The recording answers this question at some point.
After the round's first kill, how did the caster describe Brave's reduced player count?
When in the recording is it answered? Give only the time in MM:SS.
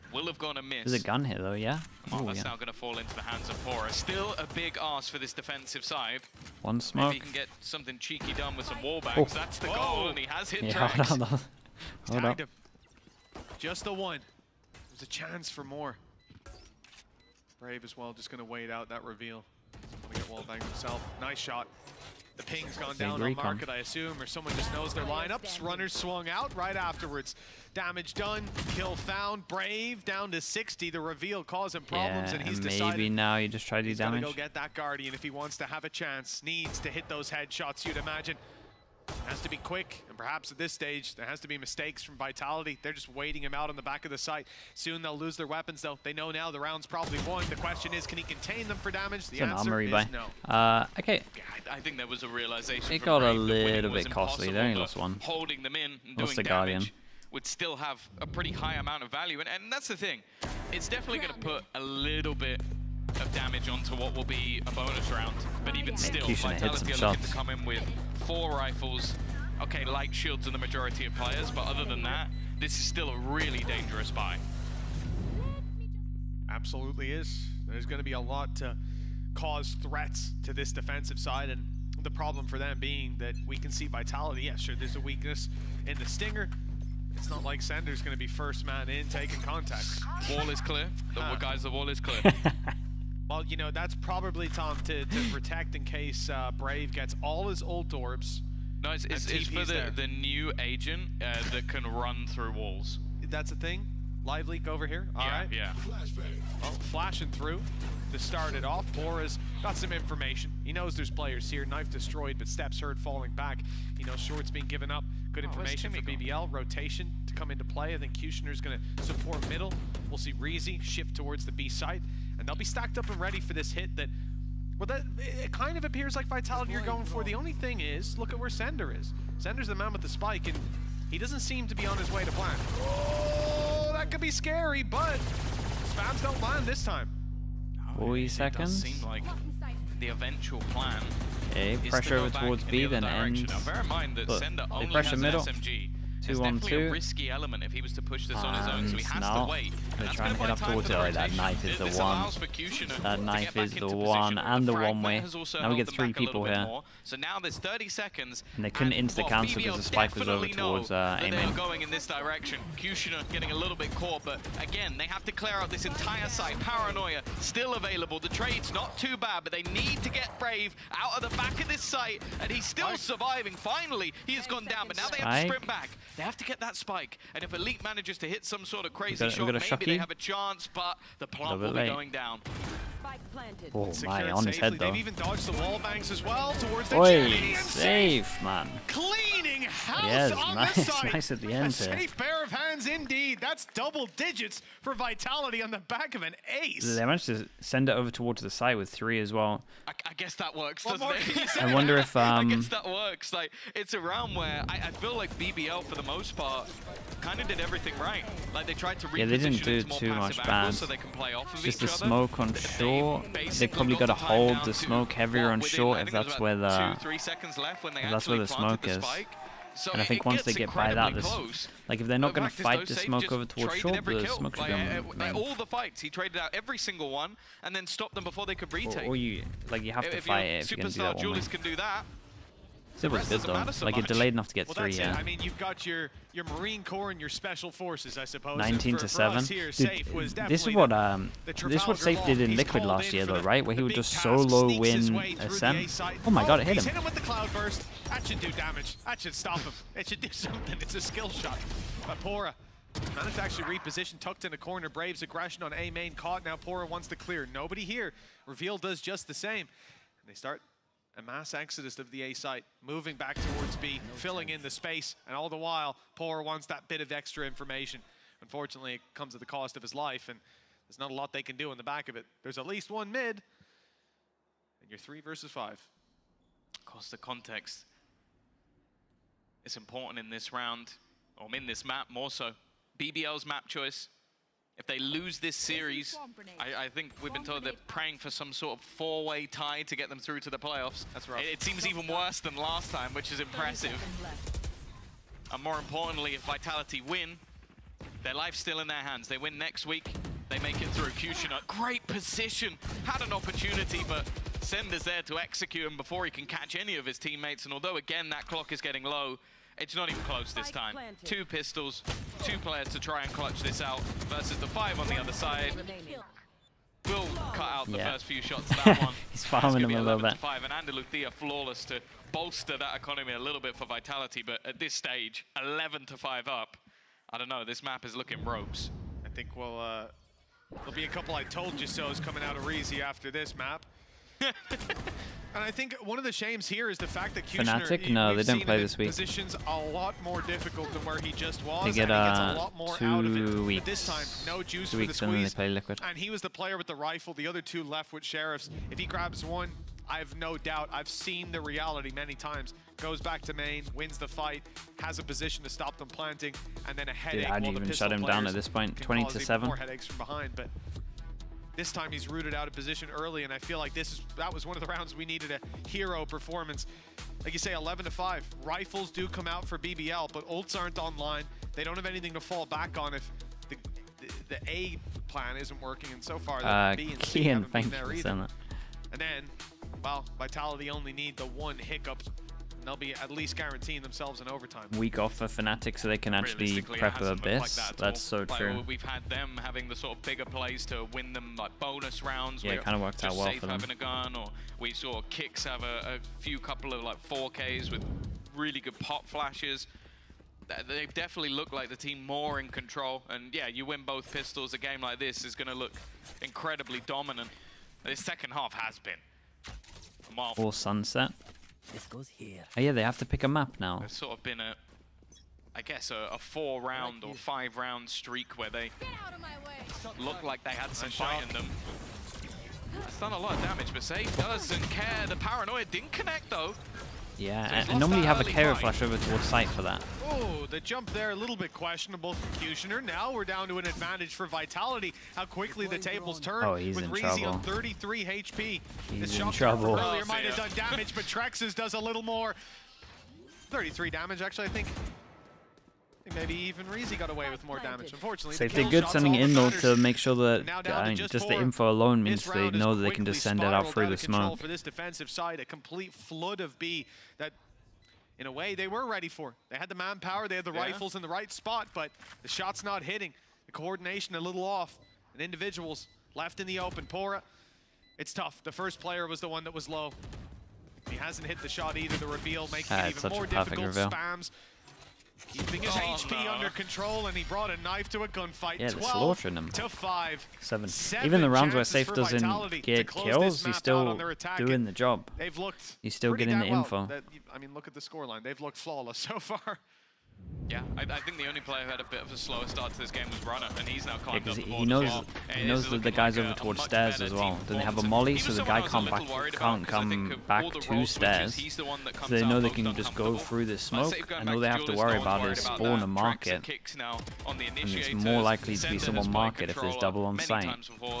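00:29.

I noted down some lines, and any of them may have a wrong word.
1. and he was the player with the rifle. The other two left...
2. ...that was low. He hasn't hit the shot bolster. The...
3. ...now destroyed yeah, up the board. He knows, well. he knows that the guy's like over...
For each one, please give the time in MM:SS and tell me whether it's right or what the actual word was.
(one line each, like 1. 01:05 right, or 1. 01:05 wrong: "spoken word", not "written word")
1. 05:46 right
2. 07:49 wrong: "either", not "bolster"
3. 08:14 wrong: "climbed", not "destroyed".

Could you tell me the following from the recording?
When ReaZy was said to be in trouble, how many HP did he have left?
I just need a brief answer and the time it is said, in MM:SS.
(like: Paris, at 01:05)
33, at 07:17.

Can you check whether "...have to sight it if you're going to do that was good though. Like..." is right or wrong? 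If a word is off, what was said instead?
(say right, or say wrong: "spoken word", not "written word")
wrong: "fight", not "sight".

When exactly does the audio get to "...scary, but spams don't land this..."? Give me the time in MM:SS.
02:14.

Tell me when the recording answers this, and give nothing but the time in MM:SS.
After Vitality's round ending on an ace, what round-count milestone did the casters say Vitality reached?
03:13.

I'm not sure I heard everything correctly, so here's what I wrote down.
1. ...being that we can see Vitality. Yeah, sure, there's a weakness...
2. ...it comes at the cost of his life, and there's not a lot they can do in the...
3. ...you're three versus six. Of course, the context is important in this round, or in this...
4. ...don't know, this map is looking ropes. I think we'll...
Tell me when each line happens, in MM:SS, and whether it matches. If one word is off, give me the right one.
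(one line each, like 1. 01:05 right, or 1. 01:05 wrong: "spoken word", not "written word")
1. 01:22 right
2. 04:28 right
3. 04:34 wrong: "five", not "six"
4. 05:27 right.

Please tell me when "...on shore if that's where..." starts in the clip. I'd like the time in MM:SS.
03:35.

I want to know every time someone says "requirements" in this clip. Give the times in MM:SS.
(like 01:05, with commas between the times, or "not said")
not said.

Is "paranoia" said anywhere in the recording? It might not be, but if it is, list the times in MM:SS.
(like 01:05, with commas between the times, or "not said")
02:46, 07:05.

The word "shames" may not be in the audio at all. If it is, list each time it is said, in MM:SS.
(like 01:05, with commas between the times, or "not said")
05:36.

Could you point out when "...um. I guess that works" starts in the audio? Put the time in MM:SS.
03:22.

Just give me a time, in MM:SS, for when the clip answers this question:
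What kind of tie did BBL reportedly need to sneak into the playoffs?
04:48.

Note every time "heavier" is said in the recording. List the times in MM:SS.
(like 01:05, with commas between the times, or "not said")
03:35.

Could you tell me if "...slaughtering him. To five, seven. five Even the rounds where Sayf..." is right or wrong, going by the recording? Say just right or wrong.
wrong.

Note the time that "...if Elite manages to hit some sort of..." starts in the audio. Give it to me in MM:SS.
02:57.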